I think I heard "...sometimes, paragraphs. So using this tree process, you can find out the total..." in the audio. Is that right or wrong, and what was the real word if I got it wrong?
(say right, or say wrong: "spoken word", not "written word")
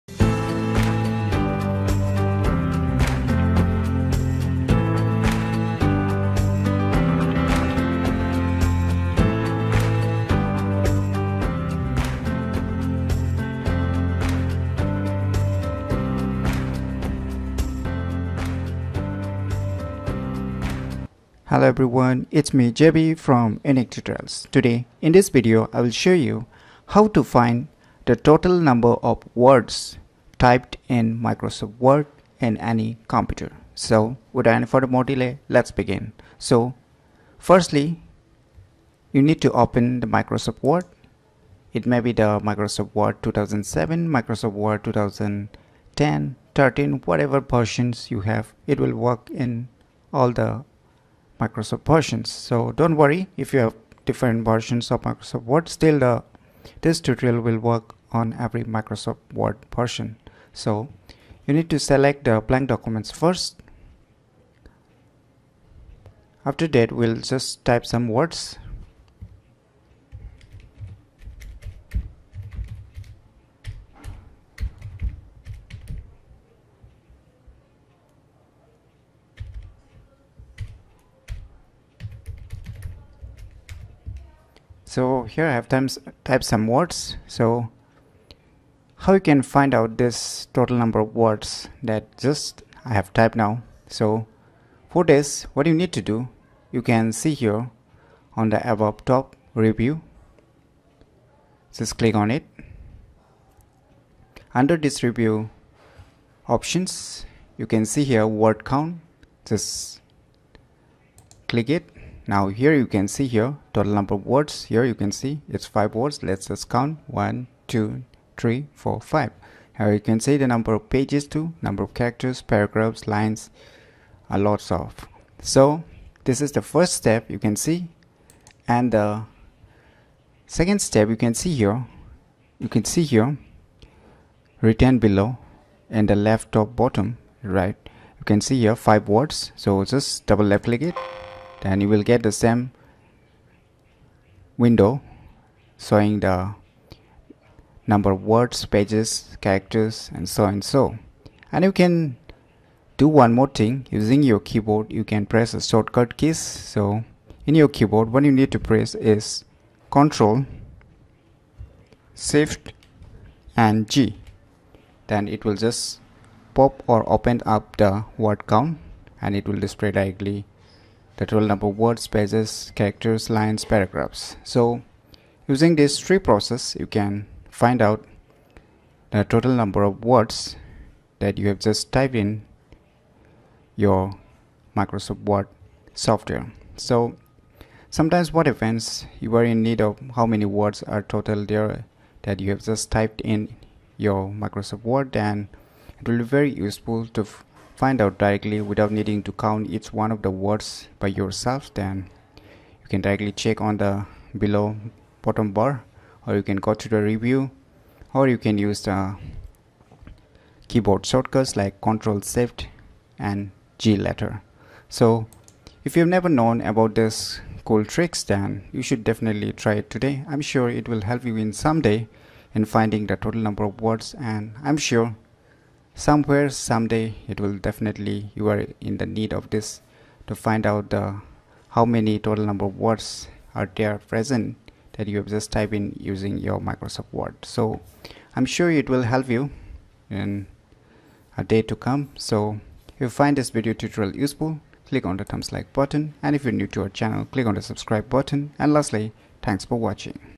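wrong: "lines", not "sometimes".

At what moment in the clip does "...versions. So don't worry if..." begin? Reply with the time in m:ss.
0:51.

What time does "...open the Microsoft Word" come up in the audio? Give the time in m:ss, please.
0:39.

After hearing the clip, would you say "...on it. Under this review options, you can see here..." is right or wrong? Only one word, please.
right.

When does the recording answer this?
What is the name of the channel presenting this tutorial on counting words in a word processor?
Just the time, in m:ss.
0:23.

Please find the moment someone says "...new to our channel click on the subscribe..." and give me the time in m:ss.
4:06.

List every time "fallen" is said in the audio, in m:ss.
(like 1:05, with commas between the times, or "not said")
not said.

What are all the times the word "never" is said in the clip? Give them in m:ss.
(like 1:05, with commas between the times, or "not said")
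3:36.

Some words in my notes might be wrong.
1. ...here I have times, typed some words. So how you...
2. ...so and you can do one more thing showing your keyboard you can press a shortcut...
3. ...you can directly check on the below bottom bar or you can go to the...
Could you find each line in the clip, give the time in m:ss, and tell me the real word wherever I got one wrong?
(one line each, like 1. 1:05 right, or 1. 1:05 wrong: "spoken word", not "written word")
1. 1:25 right
2. 2:30 wrong: "using", not "showing"
3. 3:22 right.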